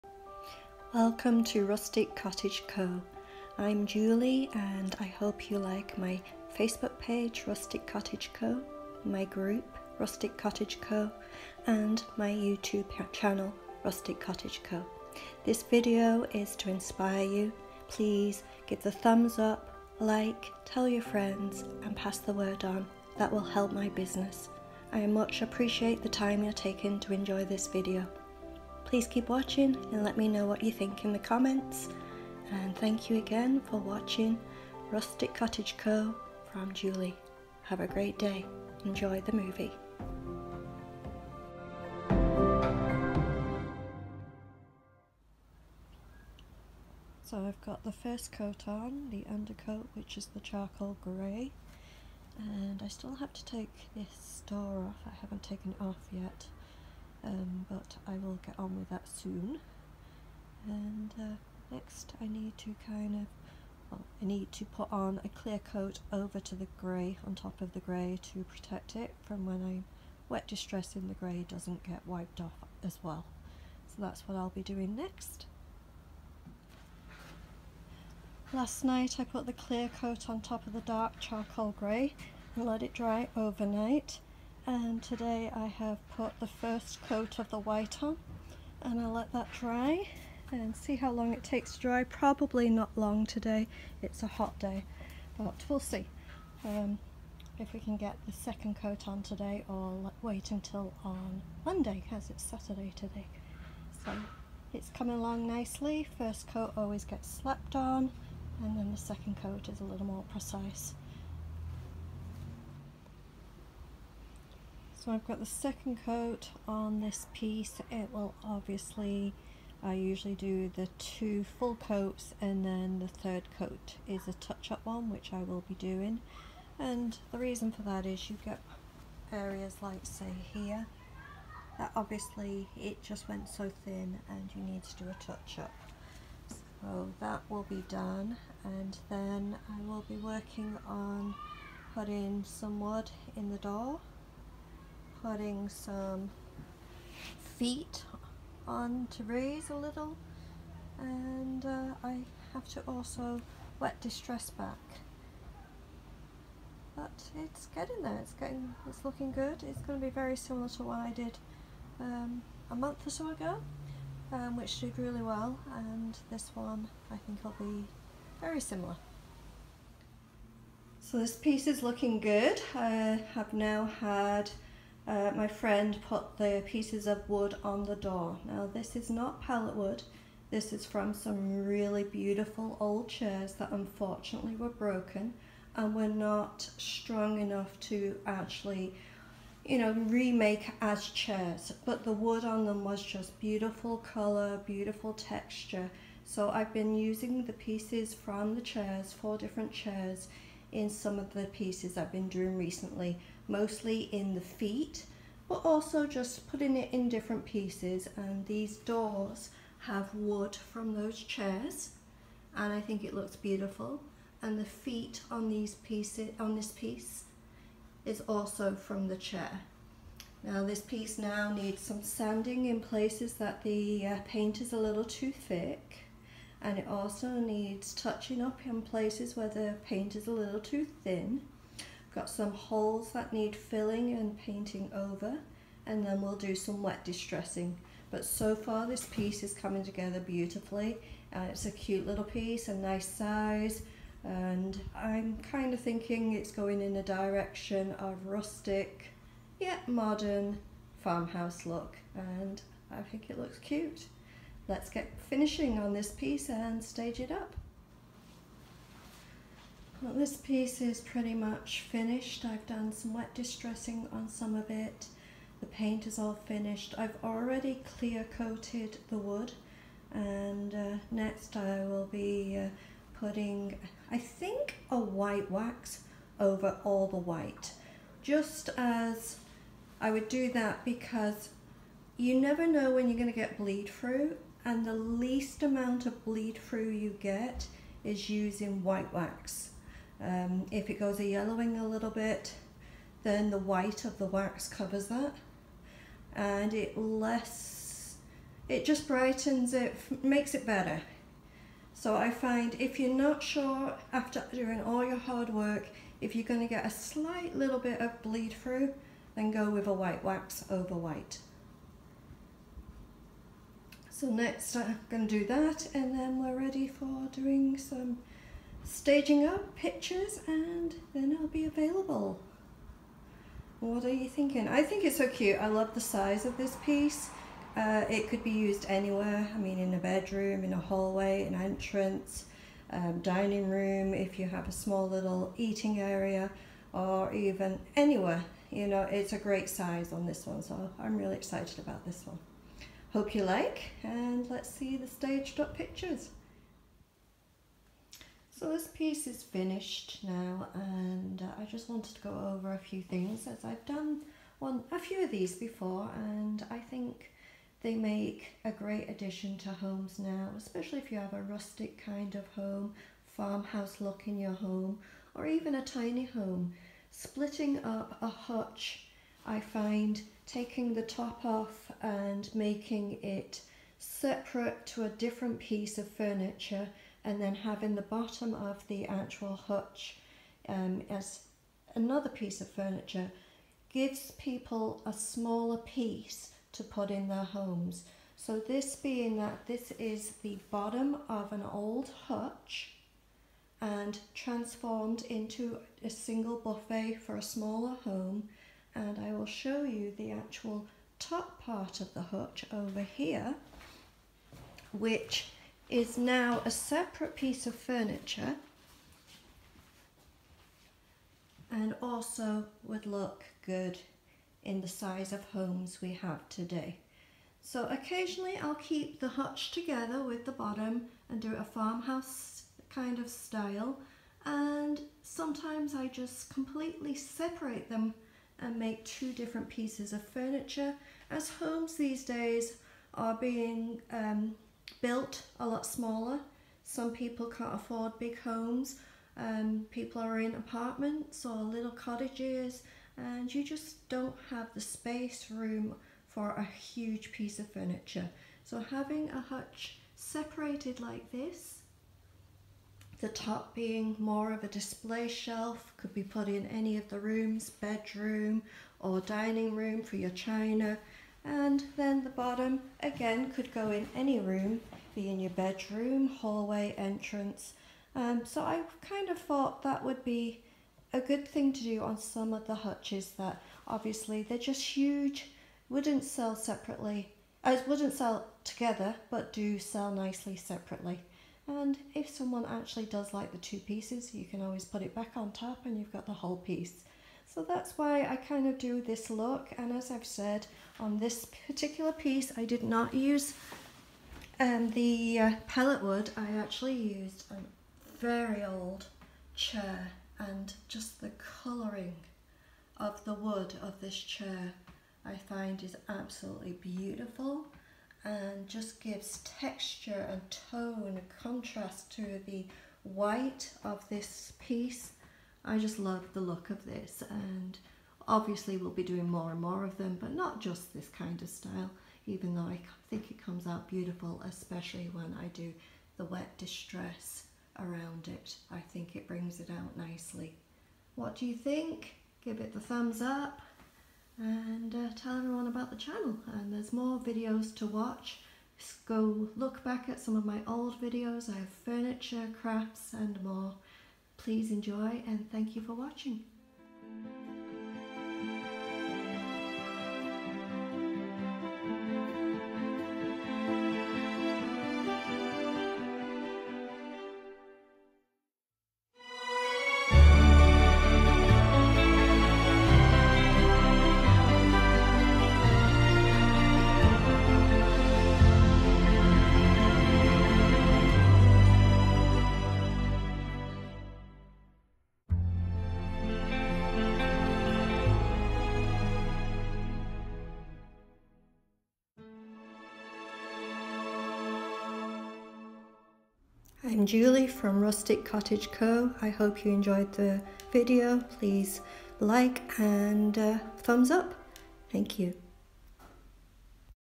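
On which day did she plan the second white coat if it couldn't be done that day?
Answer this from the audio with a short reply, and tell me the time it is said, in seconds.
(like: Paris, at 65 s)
Monday, at 101 s.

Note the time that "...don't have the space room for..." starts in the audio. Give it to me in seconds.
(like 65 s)
444 s.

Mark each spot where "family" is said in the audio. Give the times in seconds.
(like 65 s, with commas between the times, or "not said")
not said.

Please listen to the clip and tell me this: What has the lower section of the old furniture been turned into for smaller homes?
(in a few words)
single buffet.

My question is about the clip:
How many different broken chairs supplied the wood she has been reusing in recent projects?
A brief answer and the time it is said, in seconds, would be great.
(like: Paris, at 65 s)
4, at 199 s.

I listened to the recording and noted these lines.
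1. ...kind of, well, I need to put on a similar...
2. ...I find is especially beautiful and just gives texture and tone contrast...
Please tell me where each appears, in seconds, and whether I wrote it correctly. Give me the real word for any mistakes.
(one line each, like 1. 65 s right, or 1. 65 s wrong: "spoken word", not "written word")
1. 62 s wrong: "clear", not "similar"
2. 505 s wrong: "absolutely", not "especially".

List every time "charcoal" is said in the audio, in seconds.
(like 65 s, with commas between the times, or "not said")
50 s, 81 s.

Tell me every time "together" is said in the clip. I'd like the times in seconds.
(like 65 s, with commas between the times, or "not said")
239 s, 419 s, 478 s.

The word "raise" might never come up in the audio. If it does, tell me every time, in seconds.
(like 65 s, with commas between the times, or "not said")
149 s.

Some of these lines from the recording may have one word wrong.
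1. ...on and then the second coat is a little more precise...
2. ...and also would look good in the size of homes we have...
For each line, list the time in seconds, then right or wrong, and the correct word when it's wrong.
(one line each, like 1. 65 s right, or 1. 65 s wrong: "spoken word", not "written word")
1. 107 s right
2. 411 s right.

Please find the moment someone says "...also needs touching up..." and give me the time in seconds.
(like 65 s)
226 s.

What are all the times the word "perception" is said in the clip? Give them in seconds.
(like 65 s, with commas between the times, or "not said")
not said.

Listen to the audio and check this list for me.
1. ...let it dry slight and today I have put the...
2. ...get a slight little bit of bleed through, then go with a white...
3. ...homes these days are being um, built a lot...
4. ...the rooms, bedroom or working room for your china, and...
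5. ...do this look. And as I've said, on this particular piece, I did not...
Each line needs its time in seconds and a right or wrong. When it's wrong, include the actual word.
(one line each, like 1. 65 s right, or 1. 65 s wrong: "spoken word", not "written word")
1. 82 s wrong: "overnight", not "slight"
2. 306 s right
3. 431 s right
4. 457 s wrong: "dining", not "working"
5. 488 s right.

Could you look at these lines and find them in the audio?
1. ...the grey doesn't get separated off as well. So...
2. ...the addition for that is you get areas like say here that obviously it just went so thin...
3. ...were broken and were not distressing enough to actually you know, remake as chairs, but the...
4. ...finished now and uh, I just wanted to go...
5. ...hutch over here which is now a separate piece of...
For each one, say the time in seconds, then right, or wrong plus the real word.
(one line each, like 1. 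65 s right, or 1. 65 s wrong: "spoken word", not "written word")
1. 71 s wrong: "wiped", not "separated"
2. 127 s wrong: "reason", not "addition"
3. 184 s wrong: "strong", not "distressing"
4. 349 s right
5. 402 s right.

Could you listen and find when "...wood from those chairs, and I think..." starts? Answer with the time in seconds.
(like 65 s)
210 s.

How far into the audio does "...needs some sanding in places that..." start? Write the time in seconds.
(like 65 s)
221 s.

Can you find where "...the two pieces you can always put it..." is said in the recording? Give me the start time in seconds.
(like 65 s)
483 s.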